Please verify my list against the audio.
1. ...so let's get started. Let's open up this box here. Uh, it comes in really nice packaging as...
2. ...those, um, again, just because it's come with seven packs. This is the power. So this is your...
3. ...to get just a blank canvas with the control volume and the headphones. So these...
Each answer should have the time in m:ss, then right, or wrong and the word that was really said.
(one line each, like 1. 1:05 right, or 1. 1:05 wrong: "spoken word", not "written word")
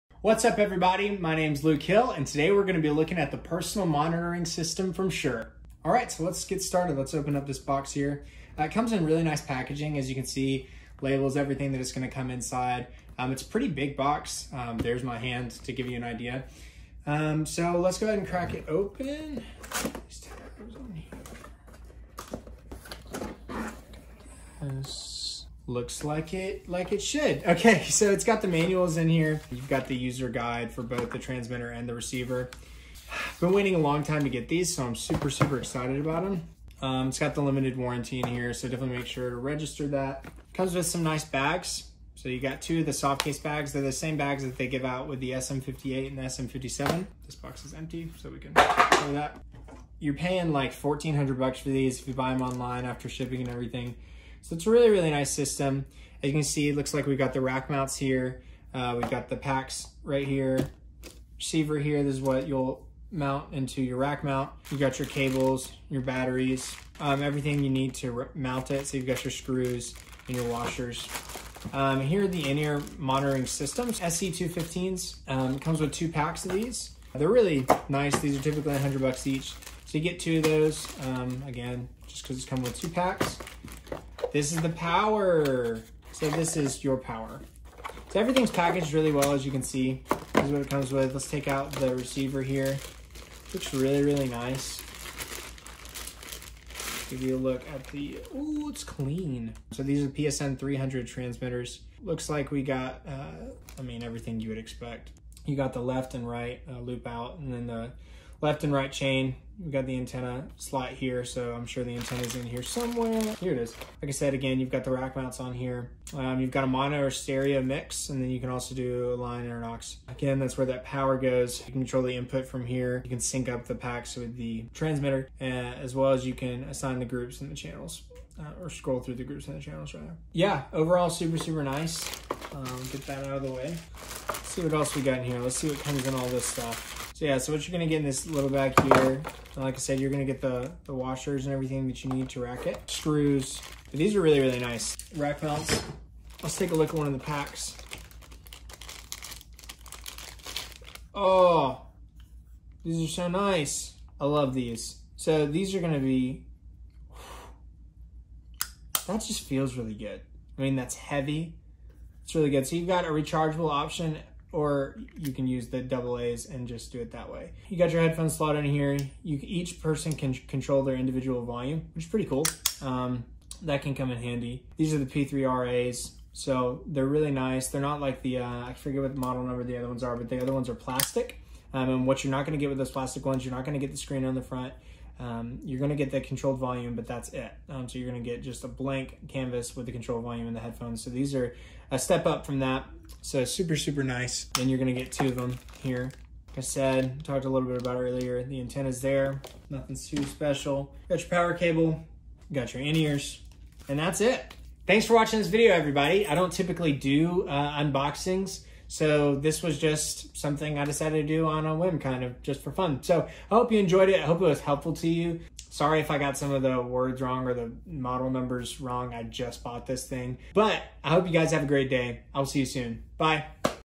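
1. 0:06 right
2. 1:20 wrong: "two", not "seven"
3. 3:08 right.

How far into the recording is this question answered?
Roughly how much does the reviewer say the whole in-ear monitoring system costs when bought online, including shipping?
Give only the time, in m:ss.
0:50.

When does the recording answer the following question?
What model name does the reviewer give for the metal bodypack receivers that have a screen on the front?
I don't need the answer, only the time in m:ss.
2:55.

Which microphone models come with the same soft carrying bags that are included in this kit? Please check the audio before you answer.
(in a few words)
SM58 and SM57.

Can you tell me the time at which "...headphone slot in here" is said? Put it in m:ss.
2:48.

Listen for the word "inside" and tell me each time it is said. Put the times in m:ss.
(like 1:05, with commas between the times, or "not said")
0:12.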